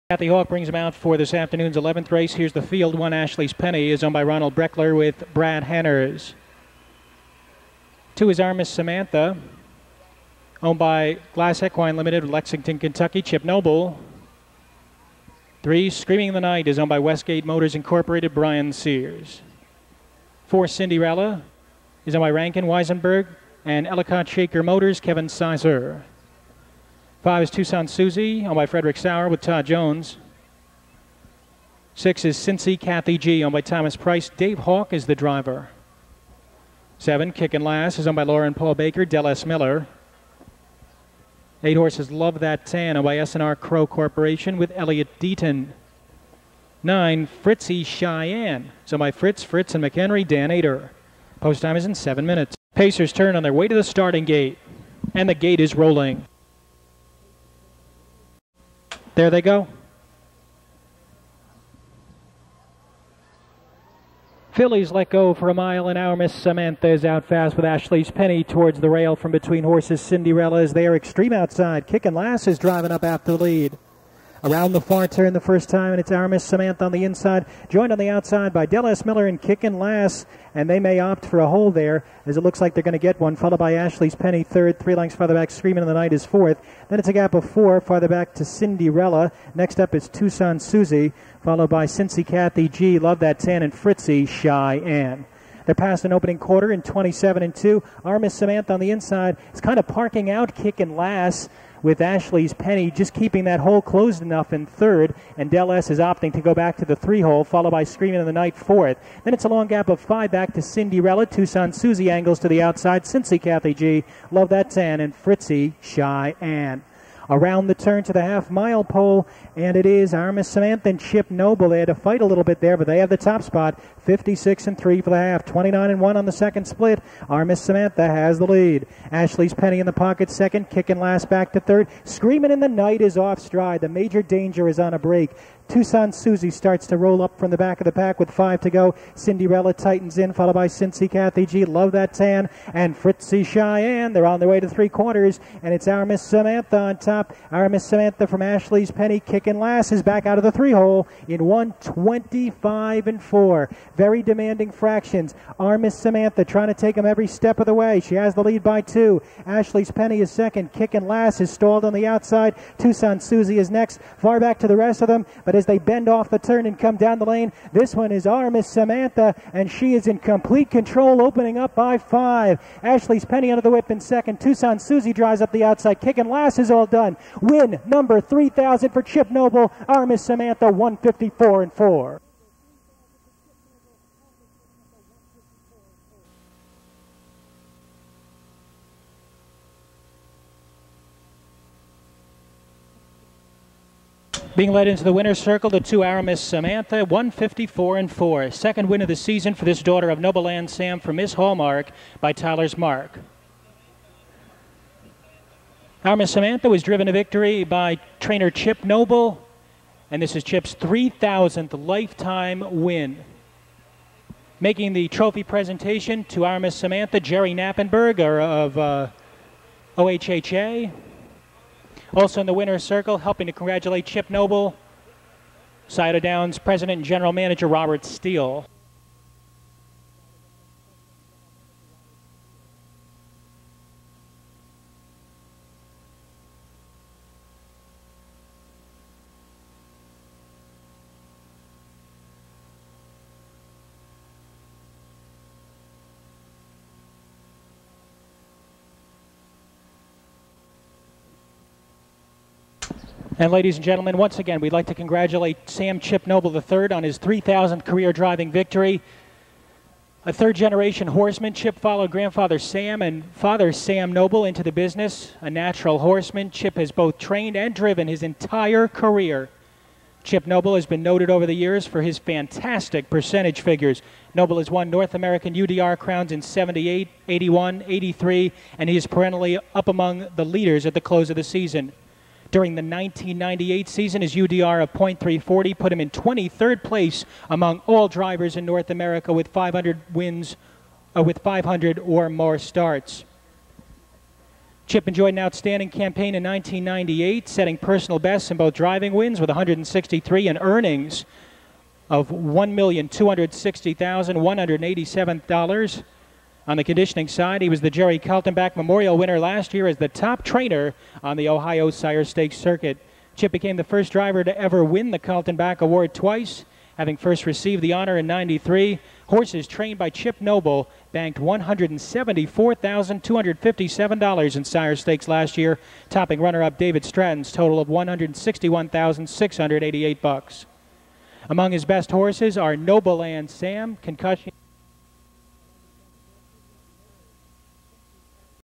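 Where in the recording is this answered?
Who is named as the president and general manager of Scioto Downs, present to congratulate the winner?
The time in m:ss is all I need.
3:47.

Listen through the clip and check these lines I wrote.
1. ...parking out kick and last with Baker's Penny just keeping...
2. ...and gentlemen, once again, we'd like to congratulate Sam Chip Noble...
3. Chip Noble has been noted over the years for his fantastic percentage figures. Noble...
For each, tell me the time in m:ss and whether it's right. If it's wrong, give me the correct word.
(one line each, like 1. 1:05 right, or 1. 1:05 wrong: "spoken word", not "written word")
1. 1:39 wrong: "Ashley", not "Baker"
2. 4:13 right
3. 4:30 right.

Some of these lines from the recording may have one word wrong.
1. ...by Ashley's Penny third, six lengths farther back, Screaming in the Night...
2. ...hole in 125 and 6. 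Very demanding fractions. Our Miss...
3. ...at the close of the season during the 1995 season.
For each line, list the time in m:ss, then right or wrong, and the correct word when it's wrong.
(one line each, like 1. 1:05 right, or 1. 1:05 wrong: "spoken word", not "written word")
1. 1:23 wrong: "three", not "six"
2. 2:30 wrong: "4", not "6"
3. 4:40 wrong: "1998", not "1995".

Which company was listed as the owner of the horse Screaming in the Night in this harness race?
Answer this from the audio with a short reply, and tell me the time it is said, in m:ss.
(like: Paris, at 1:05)
Westgate Motors Incorporated, at 0:16.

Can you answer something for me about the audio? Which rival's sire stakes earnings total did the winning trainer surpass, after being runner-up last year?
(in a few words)
David Stratton.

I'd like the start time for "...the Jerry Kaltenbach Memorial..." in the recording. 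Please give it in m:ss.
5:07.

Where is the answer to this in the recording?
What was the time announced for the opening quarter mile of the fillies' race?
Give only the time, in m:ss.
1:36.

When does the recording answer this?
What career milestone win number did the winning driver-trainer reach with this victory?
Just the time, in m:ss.
2:57.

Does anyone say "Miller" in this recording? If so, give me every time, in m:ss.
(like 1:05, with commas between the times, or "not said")
0:39, 1:19.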